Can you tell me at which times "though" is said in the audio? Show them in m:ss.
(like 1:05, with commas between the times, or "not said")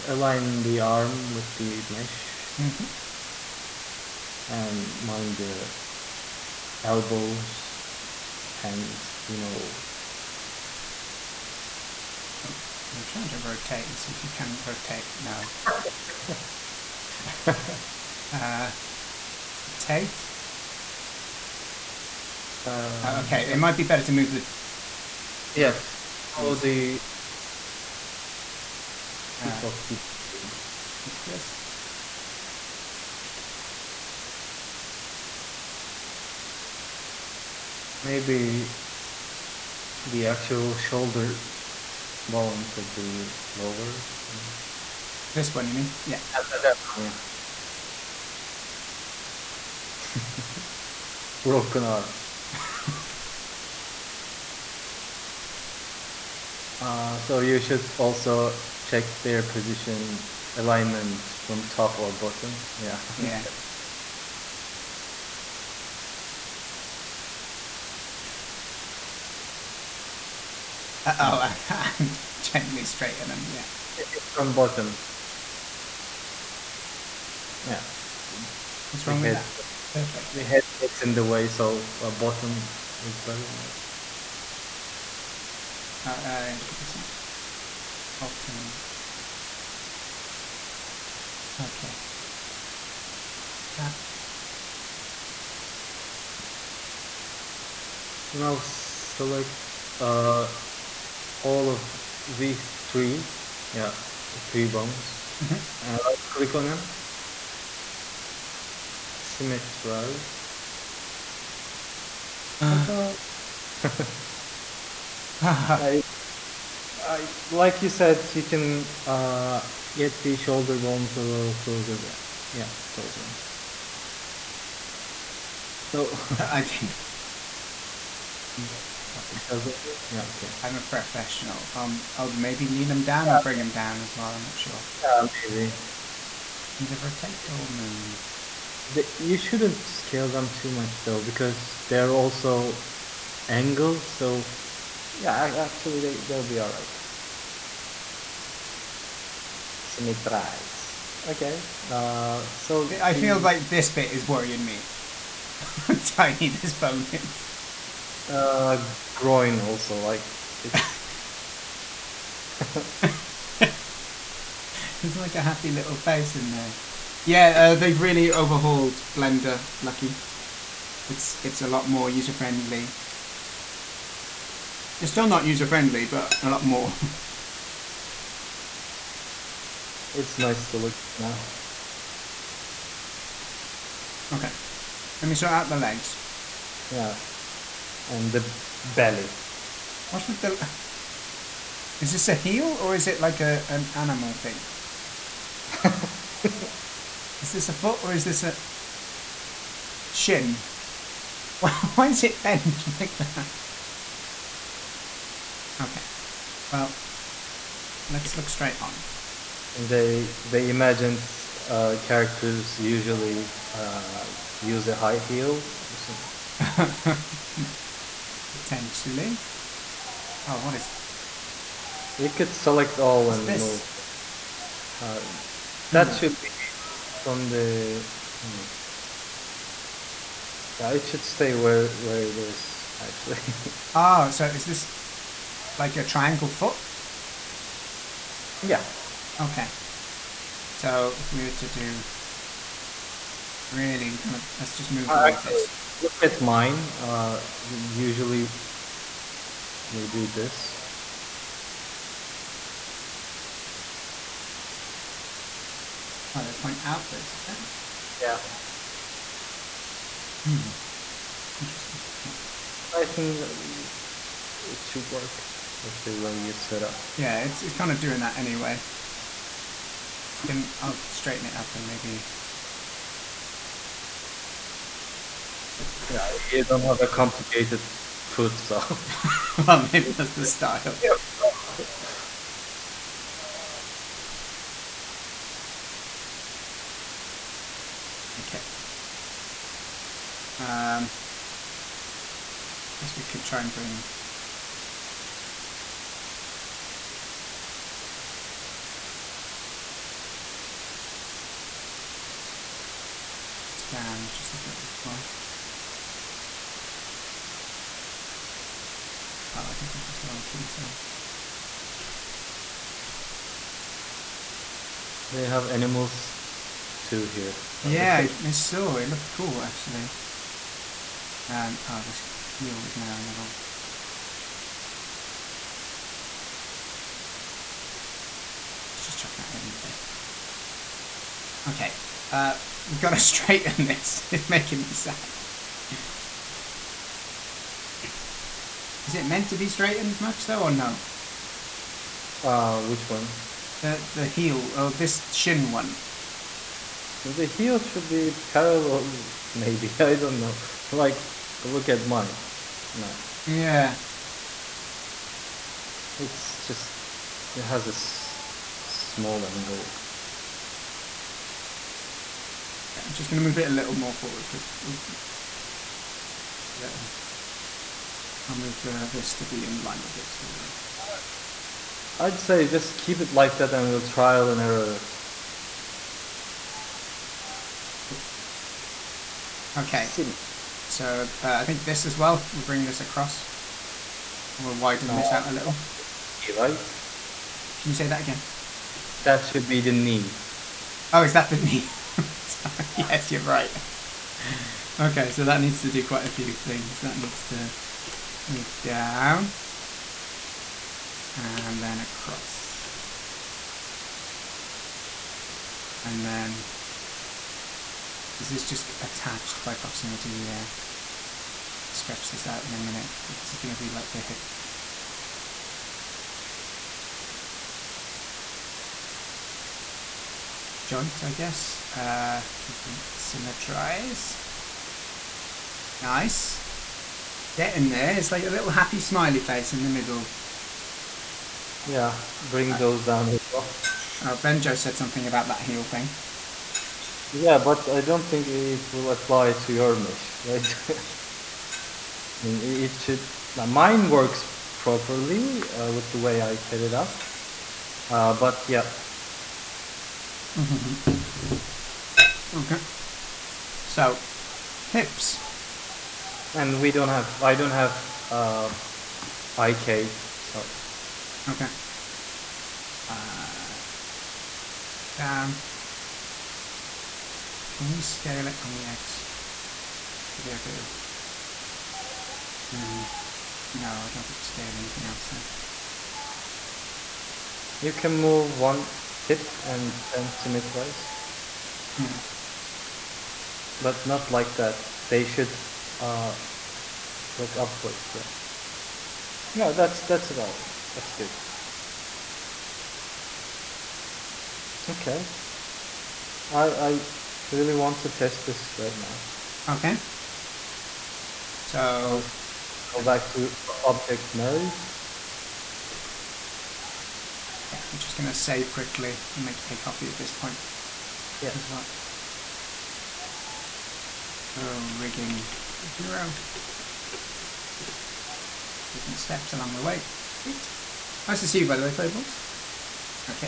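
2:21, 5:40, 6:10.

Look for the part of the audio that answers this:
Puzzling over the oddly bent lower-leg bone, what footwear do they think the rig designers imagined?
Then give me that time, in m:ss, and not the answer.
3:34.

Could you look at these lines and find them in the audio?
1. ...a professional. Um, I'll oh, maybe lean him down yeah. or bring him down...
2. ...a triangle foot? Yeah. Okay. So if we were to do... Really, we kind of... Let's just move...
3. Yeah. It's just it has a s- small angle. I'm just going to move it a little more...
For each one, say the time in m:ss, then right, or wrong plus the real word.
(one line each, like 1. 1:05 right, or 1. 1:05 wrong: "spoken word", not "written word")
1. 2:10 right
2. 3:55 right
3. 5:53 right.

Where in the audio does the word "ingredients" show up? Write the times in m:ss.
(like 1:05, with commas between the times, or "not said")
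not said.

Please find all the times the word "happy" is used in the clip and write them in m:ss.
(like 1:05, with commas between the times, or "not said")
2:45, 7:08.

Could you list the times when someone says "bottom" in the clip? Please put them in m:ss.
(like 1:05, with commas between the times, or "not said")
1:02, 1:14, 1:22.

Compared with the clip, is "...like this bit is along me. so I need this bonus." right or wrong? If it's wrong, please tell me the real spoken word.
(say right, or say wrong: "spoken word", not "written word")
wrong: "worrying", not "along".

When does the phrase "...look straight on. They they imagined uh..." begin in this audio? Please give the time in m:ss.
3:28.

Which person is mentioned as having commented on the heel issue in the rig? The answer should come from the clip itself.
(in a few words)
Benjo.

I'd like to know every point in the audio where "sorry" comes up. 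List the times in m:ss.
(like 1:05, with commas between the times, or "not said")
5:10, 6:32.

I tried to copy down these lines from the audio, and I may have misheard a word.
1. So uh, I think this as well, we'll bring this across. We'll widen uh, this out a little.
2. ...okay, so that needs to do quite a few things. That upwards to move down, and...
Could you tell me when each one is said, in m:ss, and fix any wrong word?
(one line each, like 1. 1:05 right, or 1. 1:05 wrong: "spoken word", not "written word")
1. 6:20 right
2. 6:34 wrong: "needs", not "upwards".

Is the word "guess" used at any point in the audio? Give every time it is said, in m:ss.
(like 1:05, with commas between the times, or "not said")
4:53, 7:01.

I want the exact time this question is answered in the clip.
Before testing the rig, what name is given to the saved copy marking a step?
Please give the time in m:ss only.
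8:34.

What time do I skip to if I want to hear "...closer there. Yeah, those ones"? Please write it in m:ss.
2:01.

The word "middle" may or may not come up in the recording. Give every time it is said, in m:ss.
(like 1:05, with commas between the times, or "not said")
7:09.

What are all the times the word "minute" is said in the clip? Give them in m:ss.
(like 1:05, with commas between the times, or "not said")
6:52.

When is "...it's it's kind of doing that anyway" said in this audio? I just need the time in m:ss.
4:27.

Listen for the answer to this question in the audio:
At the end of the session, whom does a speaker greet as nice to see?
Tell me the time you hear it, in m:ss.
8:41.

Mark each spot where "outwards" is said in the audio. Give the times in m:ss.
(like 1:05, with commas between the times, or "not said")
4:16.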